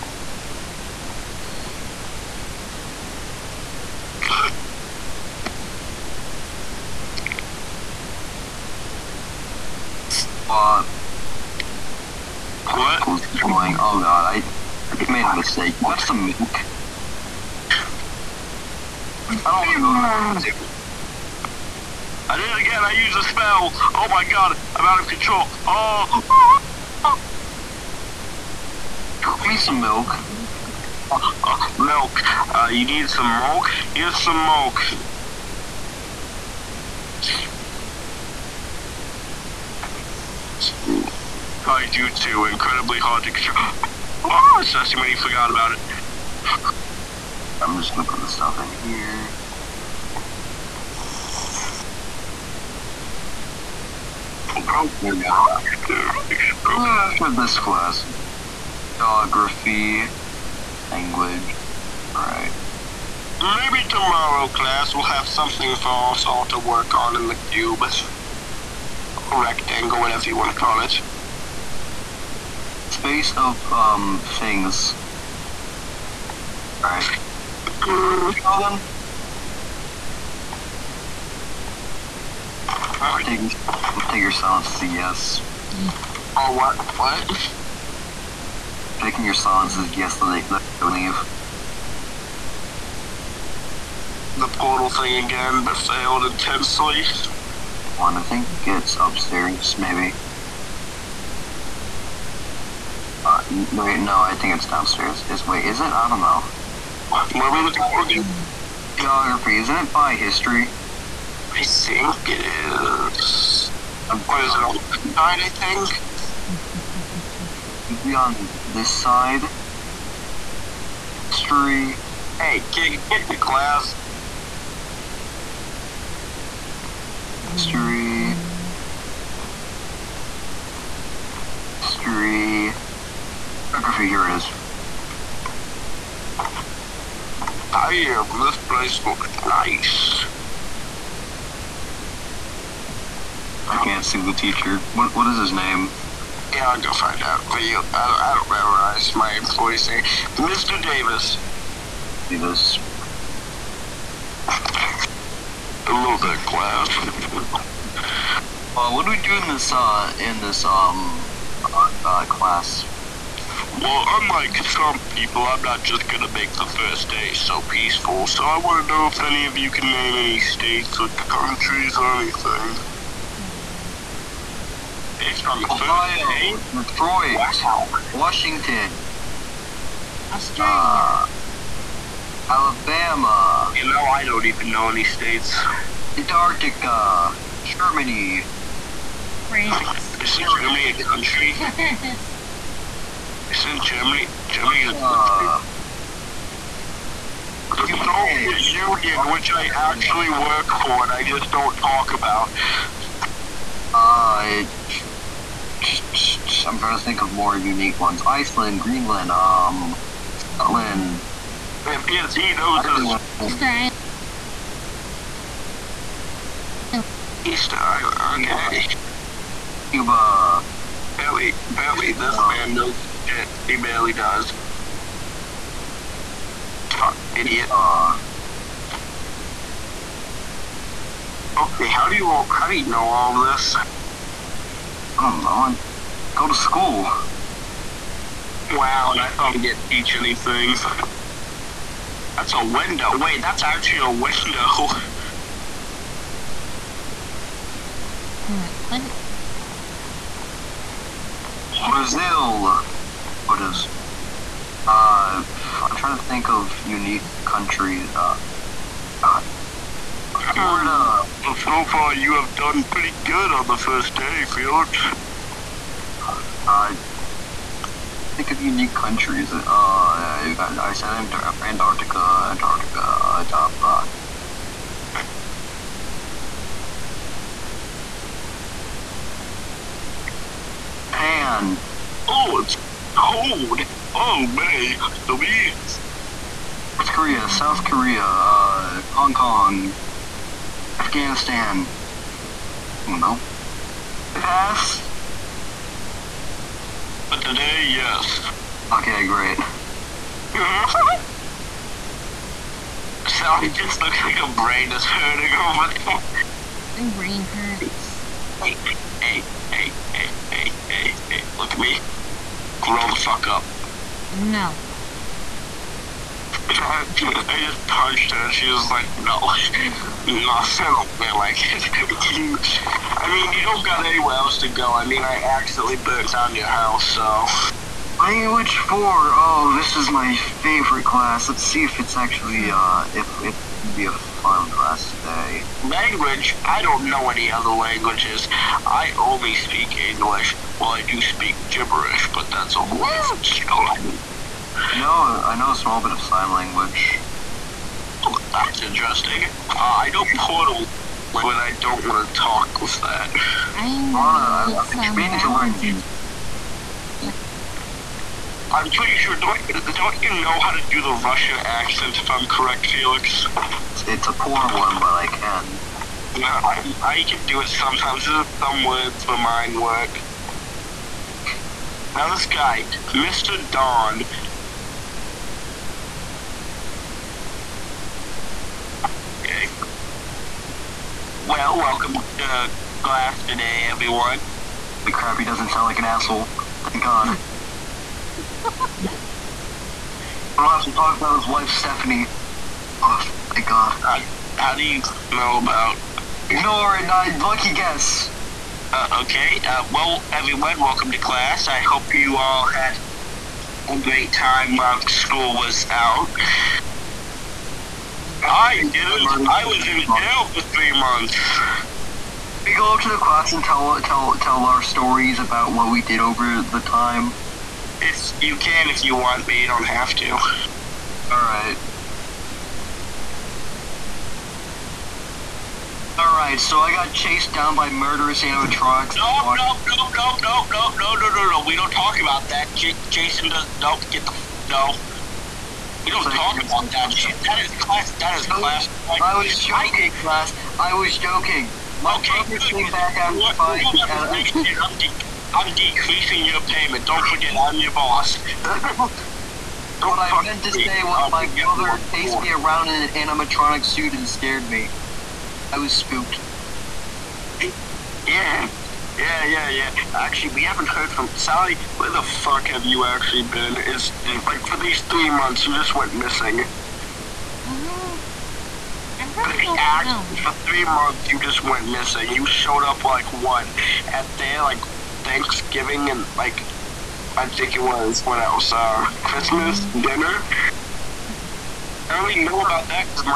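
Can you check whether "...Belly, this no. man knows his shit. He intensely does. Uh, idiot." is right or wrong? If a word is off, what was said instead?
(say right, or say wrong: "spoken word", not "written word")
wrong: "barely", not "intensely".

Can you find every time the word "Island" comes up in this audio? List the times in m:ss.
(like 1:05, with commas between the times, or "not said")
3:33, 3:37.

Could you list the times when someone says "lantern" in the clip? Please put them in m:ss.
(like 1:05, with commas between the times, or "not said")
not said.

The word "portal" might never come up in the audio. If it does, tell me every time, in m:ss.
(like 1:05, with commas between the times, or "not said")
1:34, 5:50.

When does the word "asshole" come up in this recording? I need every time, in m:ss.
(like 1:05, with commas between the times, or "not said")
6:26.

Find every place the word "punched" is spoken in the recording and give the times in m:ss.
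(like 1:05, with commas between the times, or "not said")
5:17.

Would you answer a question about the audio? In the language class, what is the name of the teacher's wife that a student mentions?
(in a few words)
Stephanie.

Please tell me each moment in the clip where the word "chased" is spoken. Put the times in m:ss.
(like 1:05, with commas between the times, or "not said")
7:07, 7:32.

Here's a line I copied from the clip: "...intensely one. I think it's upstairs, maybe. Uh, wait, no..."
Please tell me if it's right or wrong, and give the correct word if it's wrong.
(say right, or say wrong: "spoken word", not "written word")
right.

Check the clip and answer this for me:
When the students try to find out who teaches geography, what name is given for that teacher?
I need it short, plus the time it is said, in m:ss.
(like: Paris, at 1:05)
Mr. Davis, at 2:30.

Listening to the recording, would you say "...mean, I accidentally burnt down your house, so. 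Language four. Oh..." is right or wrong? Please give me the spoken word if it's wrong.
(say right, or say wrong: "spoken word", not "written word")
right.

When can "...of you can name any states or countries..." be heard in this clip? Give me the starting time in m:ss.
2:49.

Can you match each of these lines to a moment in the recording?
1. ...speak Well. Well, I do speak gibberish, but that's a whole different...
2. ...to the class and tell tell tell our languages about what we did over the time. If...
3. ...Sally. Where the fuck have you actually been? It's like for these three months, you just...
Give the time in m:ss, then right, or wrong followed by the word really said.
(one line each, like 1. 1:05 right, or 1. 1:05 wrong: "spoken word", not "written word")
1. 5:39 wrong: "English", not "Well"
2. 6:53 wrong: "stories", not "languages"
3. 7:41 right.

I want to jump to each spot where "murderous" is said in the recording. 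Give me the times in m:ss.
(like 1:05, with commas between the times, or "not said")
7:07.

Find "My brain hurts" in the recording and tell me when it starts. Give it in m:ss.
5:07.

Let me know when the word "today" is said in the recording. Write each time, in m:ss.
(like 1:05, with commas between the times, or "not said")
4:57, 5:35, 6:23.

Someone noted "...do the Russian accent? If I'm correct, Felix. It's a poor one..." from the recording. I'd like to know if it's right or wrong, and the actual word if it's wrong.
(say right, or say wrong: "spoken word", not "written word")
right.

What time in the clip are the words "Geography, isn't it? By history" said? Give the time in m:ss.
1:48.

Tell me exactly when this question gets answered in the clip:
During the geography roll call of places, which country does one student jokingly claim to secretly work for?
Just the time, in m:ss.
3:17.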